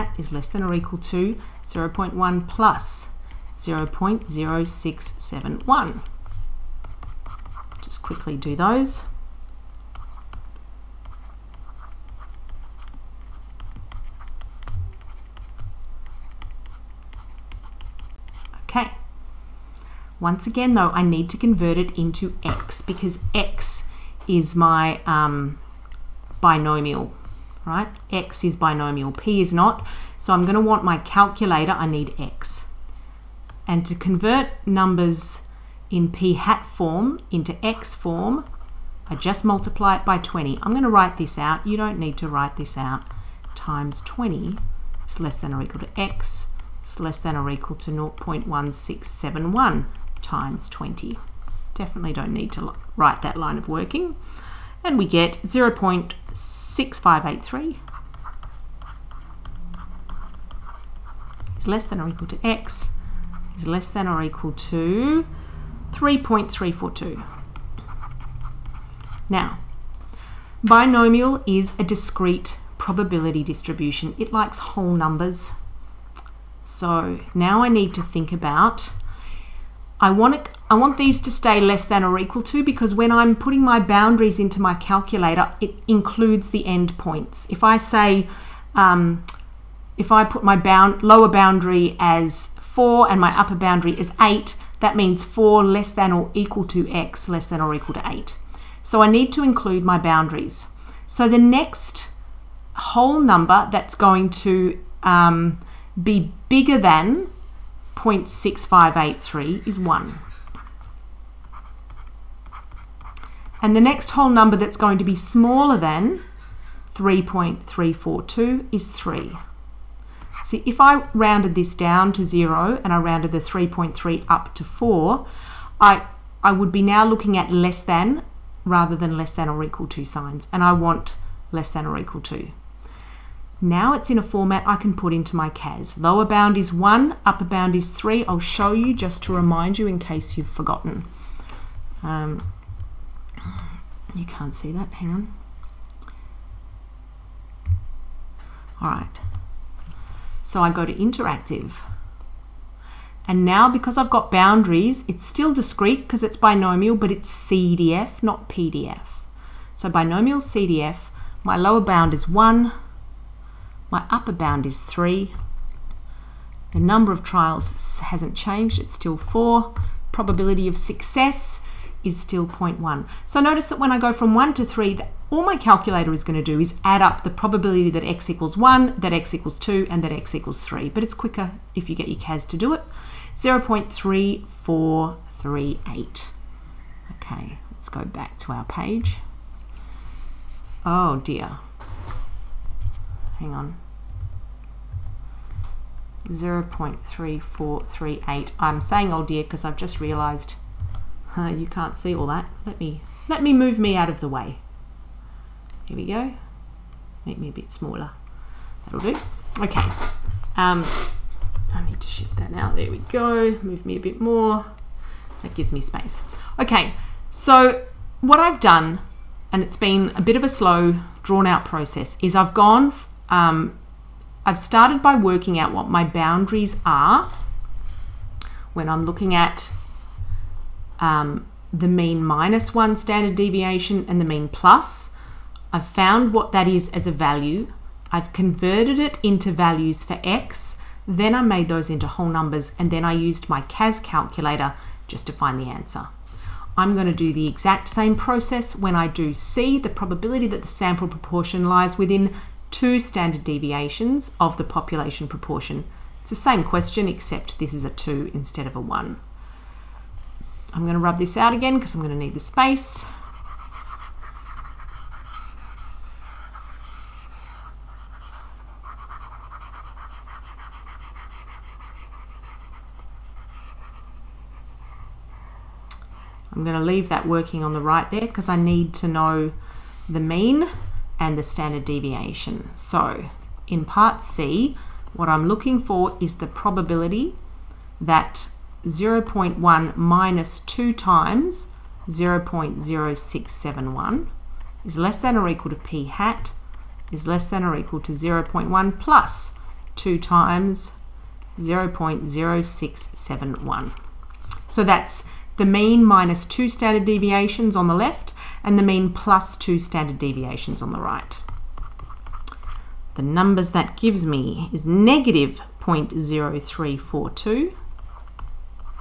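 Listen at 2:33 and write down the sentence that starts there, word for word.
And now because I've got boundaries, it's still discrete because it's binomial, but it's CDF, not PDF.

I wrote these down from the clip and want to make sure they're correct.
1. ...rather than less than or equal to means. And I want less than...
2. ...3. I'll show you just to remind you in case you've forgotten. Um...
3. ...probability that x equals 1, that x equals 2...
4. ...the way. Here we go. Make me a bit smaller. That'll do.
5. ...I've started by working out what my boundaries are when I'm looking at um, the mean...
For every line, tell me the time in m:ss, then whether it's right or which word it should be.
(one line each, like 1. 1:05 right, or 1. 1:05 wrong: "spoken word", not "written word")
1. 2:08 wrong: "signs", not "means"
2. 2:17 right
3. 2:57 right
4. 3:24 right
5. 3:44 right.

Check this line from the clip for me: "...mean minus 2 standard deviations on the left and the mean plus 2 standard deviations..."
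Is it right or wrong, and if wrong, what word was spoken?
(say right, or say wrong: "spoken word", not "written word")
right.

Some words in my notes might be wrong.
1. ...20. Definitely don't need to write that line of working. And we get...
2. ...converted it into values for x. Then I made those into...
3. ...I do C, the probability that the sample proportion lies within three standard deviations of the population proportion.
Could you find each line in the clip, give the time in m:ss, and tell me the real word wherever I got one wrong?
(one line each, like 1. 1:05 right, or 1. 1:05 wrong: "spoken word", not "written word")
1. 0:50 right
2. 3:58 right
3. 4:08 wrong: "two", not "three".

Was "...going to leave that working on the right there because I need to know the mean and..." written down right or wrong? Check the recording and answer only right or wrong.
right.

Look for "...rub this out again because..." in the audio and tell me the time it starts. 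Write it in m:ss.
4:20.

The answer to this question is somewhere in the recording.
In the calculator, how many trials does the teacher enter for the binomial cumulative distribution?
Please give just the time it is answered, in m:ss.
2:48.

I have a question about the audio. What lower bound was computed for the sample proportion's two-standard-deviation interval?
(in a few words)
-0.0342.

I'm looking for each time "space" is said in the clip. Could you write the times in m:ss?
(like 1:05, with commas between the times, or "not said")
3:35, 4:22.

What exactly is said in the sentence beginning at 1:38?
So I need to include my boundaries.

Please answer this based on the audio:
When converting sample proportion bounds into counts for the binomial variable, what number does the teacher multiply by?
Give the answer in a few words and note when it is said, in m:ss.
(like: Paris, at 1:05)
20, at 0:39.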